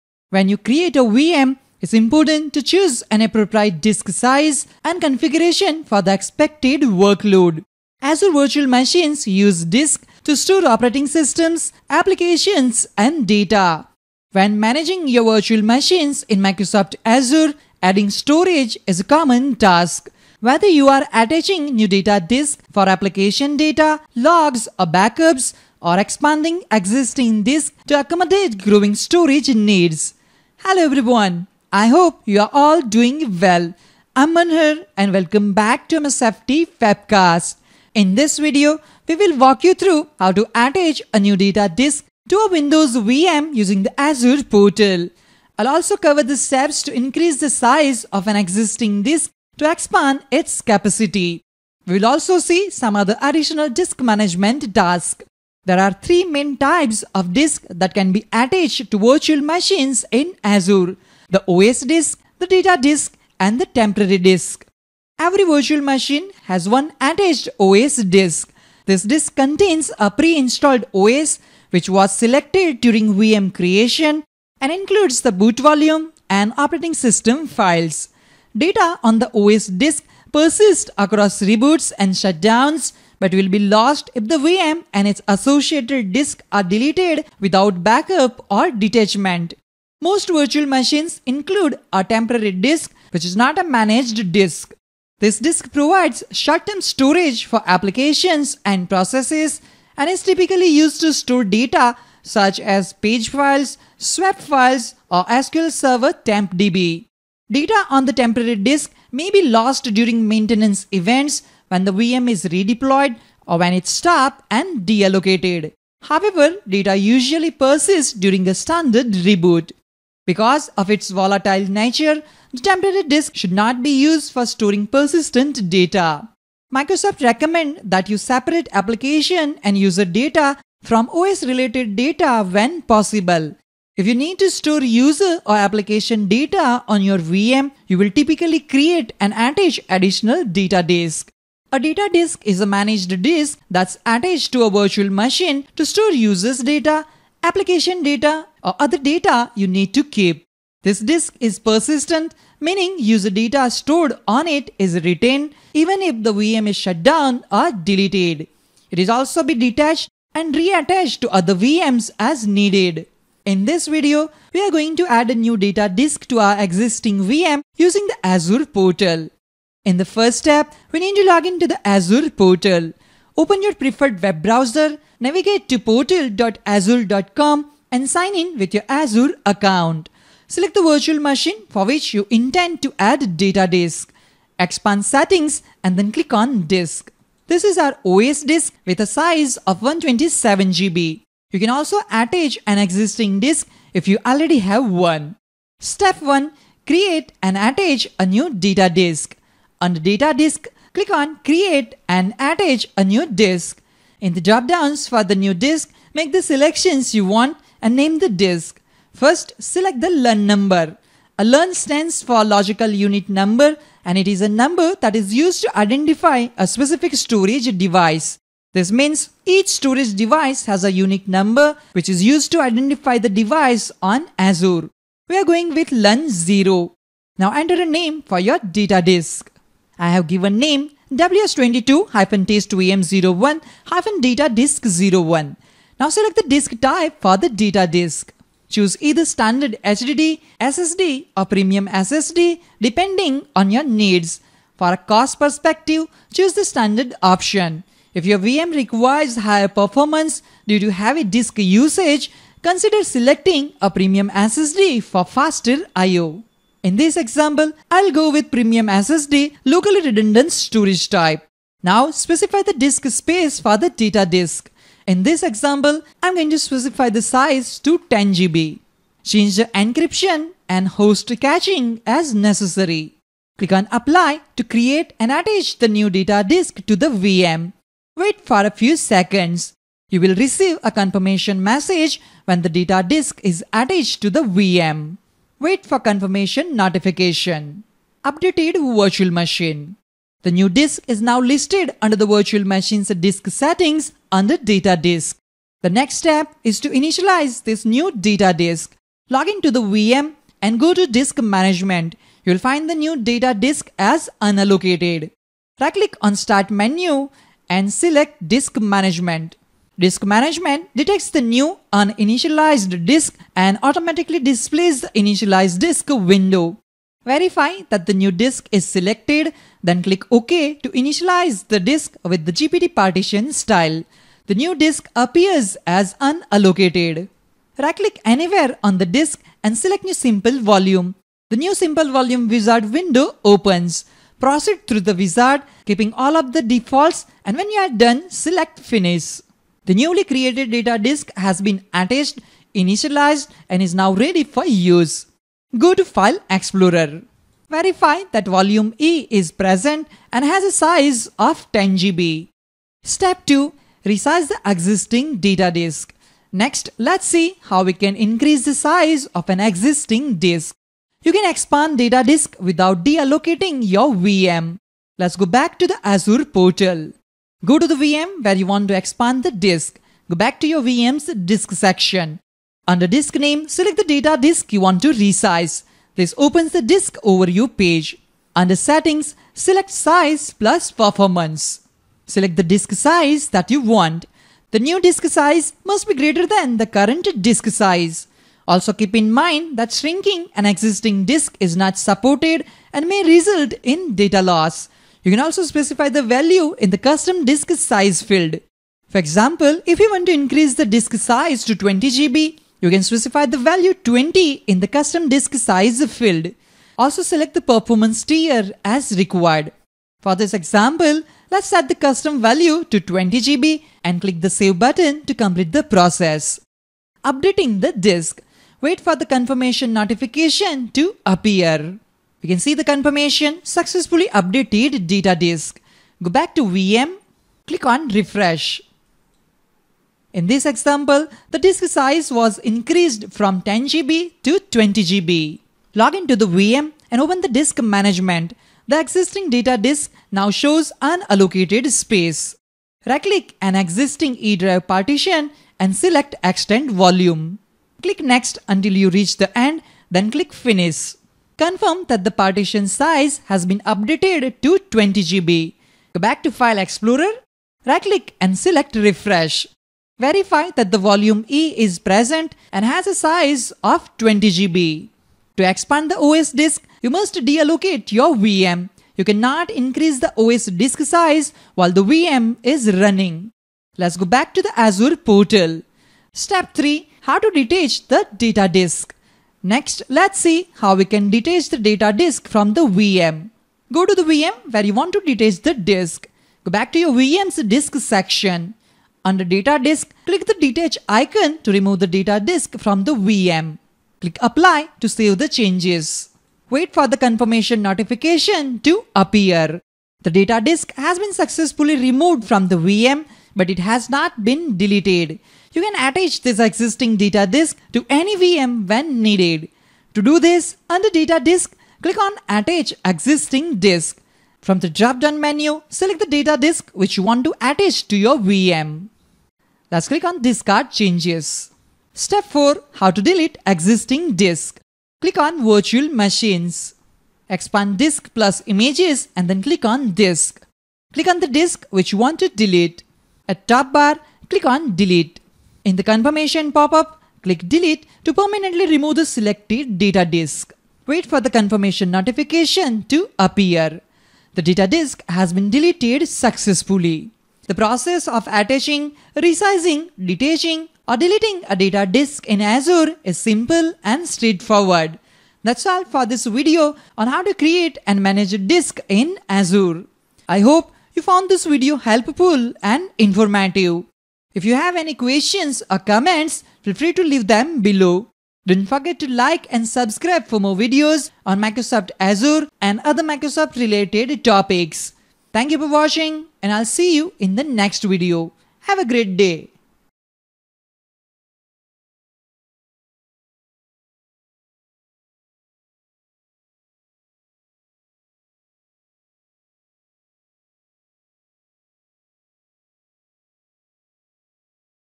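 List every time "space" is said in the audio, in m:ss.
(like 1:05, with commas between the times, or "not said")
4:23, 7:21.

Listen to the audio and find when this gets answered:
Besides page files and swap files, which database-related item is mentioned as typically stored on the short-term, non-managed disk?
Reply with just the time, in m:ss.
1:45.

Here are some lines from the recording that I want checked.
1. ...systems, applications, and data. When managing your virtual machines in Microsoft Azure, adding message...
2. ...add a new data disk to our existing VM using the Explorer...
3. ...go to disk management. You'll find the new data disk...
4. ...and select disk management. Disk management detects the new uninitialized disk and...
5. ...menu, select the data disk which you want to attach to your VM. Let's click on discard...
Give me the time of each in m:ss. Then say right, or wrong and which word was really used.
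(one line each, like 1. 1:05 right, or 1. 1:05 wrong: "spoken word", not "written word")
1. 0:11 wrong: "storage", not "message"
2. 2:45 wrong: "Azure", not "Explorer"
3. 5:00 right
4. 5:07 right
5. 8:35 right.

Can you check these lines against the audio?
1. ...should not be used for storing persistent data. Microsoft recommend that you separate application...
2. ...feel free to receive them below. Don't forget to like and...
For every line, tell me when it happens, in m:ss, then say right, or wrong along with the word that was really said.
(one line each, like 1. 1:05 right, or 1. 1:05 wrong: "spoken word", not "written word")
1. 2:03 right
2. 9:26 wrong: "leave", not "receive".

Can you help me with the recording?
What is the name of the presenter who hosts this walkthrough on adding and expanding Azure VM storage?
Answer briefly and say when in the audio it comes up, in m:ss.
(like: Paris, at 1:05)
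Manhar, at 0:34.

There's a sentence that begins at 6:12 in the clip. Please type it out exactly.
Under disk name, select the data disk you want to resize.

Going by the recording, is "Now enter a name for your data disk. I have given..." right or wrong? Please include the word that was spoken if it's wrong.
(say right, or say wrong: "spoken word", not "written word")
right.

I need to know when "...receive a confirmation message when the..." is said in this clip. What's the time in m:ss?
4:40.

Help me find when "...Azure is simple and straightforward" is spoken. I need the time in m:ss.
9:12.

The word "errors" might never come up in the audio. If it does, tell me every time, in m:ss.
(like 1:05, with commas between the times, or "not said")
not said.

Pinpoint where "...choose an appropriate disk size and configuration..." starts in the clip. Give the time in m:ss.
0:02.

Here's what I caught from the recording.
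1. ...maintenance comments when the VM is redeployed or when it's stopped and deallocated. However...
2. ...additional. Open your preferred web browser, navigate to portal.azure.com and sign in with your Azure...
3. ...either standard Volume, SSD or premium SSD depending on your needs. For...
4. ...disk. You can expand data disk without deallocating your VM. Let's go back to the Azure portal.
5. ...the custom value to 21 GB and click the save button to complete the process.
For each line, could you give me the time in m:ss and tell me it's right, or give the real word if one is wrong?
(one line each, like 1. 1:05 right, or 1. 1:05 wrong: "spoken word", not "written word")
1. 1:50 wrong: "events", not "comments"
2. 2:52 wrong: "portal", not "additional"
3. 3:58 wrong: "HDD", not "Volume"
4. 6:00 right
5. 6:51 wrong: "20", not "21".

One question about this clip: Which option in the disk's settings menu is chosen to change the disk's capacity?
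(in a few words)
size plus performance.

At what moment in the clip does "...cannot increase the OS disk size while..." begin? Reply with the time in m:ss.
7:49.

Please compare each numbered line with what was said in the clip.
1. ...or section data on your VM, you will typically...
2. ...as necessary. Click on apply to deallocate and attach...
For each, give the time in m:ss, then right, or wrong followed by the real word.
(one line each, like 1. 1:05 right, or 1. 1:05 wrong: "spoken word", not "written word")
1. 2:15 wrong: "application", not "section"
2. 4:32 wrong: "create", not "deallocate".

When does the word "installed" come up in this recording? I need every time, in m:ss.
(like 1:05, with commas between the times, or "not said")
1:10.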